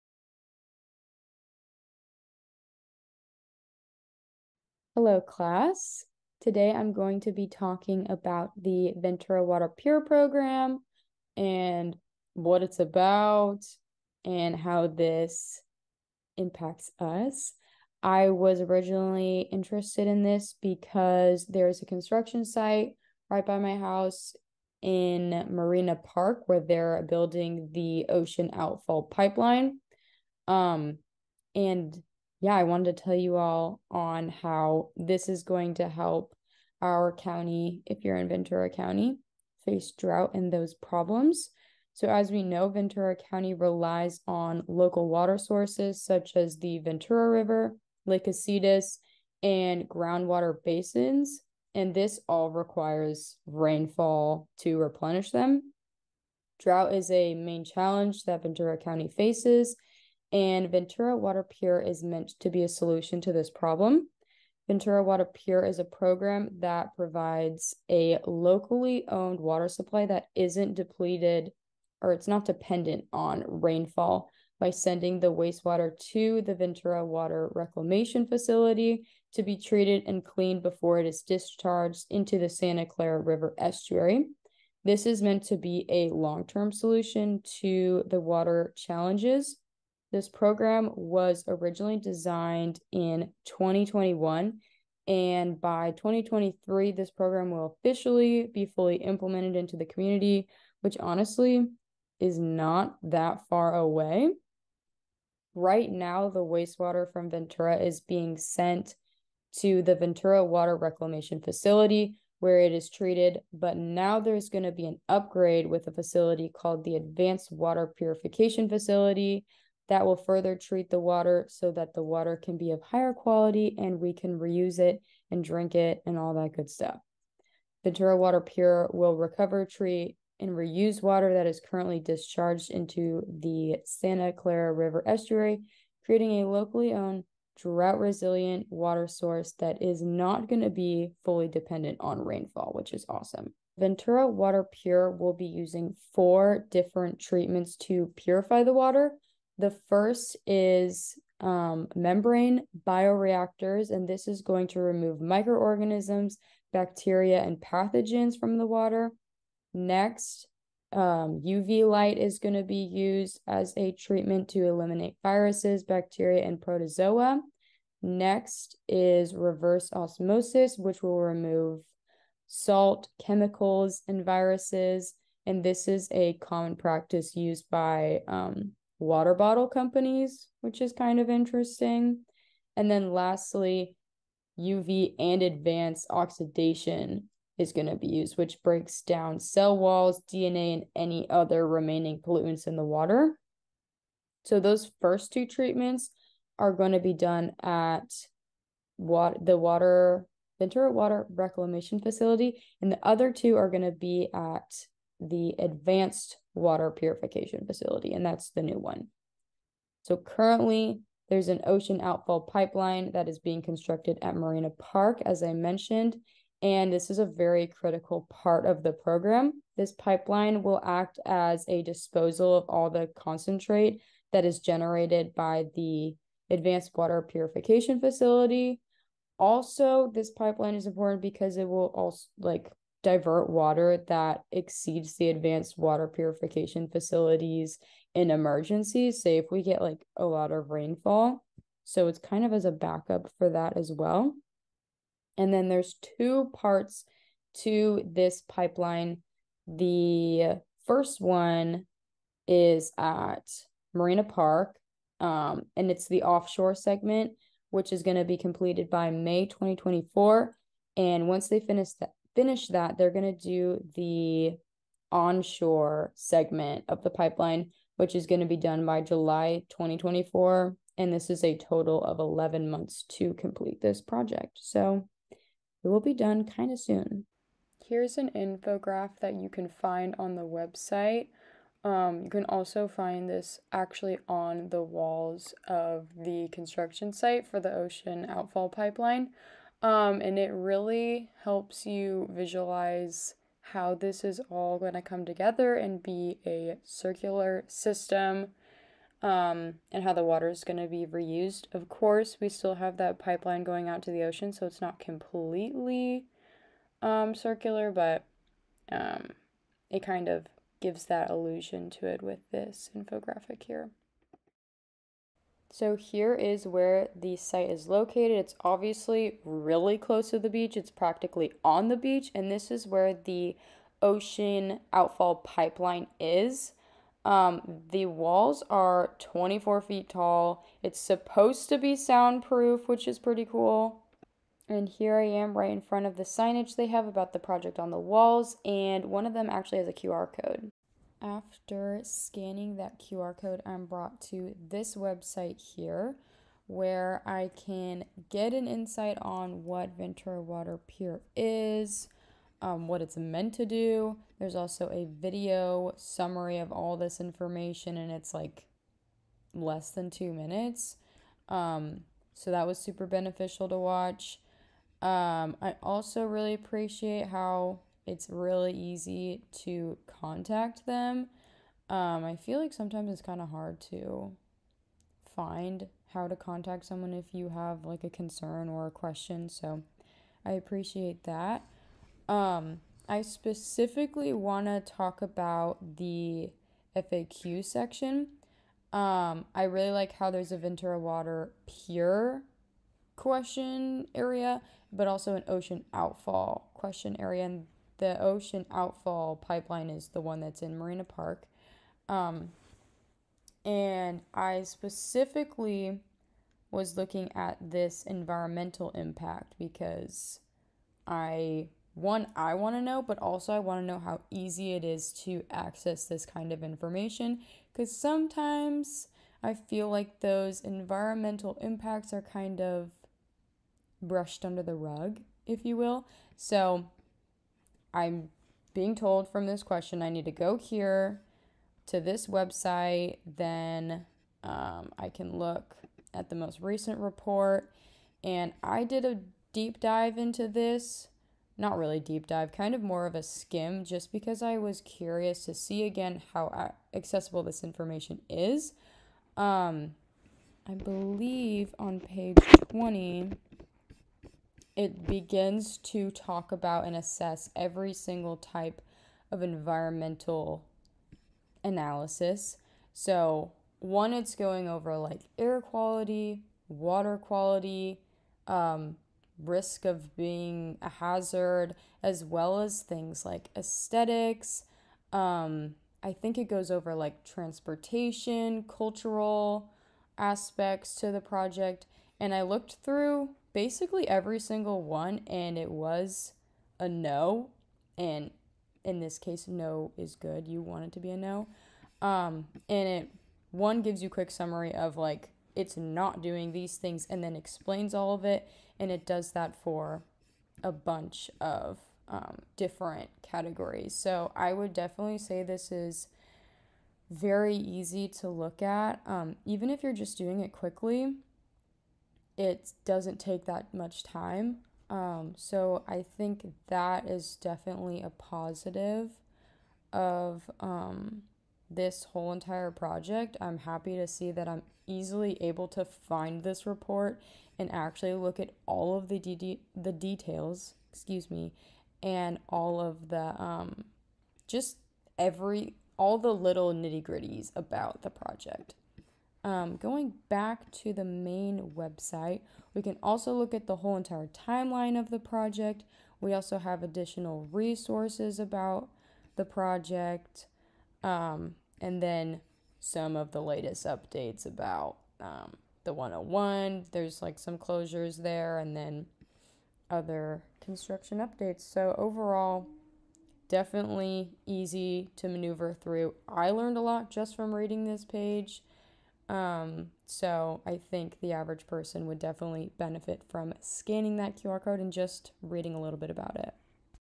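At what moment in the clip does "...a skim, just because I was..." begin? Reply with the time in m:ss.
7:23.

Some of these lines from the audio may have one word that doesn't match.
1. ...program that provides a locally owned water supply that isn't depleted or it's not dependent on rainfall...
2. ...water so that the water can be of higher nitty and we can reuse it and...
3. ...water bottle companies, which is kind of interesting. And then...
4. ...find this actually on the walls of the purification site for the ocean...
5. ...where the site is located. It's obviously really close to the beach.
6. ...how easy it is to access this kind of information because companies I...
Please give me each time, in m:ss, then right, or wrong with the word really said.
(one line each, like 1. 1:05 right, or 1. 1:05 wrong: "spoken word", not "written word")
1. 1:05 right
2. 2:01 wrong: "quality", not "nitty"
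3. 2:59 right
4. 4:42 wrong: "construction", not "purification"
5. 5:16 right
6. 6:53 wrong: "sometimes", not "companies".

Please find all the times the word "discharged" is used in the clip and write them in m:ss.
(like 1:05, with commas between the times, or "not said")
1:21, 2:11.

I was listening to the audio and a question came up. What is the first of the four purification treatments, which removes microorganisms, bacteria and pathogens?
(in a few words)
Membrane bioreactors.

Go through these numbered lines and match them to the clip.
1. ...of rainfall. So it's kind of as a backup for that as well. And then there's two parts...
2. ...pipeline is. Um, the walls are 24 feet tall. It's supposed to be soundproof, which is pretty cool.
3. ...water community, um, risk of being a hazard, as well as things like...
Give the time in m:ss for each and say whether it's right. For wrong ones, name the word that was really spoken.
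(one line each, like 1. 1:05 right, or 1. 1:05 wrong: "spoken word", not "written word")
1. 4:00 right
2. 5:25 right
3. 7:46 wrong: "quality", not "community".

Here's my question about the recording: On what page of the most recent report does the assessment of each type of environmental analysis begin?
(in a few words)
20.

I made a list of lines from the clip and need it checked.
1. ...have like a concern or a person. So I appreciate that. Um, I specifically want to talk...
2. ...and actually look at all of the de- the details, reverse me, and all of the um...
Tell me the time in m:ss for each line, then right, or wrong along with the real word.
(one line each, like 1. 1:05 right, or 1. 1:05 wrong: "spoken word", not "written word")
1. 6:17 wrong: "question", not "person"
2. 8:47 wrong: "excuse", not "reverse".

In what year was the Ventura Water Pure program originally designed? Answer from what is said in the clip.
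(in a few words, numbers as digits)
2021.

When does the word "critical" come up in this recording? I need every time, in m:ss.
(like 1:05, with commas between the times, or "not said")
3:37.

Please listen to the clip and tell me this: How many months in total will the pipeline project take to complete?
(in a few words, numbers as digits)
11.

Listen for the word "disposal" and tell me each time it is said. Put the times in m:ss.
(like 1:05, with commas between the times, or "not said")
3:41.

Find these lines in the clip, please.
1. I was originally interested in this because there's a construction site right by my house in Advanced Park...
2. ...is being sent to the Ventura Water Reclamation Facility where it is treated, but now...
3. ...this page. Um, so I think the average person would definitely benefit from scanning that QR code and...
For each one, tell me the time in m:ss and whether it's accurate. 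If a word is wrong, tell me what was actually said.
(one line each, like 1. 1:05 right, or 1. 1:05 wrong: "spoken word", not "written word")
1. 0:18 wrong: "Marina", not "Advanced"
2. 1:47 right
3. 9:27 right.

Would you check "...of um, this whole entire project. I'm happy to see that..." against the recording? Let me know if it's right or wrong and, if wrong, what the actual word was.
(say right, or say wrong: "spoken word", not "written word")
right.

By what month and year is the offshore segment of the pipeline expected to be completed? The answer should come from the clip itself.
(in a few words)
May 2024.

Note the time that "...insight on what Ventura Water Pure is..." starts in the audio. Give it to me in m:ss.
5:48.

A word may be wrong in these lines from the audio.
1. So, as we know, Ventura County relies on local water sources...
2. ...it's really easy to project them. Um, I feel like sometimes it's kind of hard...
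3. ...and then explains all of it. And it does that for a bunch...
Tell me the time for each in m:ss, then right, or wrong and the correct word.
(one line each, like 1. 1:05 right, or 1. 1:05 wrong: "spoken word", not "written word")
1. 0:41 right
2. 6:08 wrong: "contact", not "project"
3. 8:17 right.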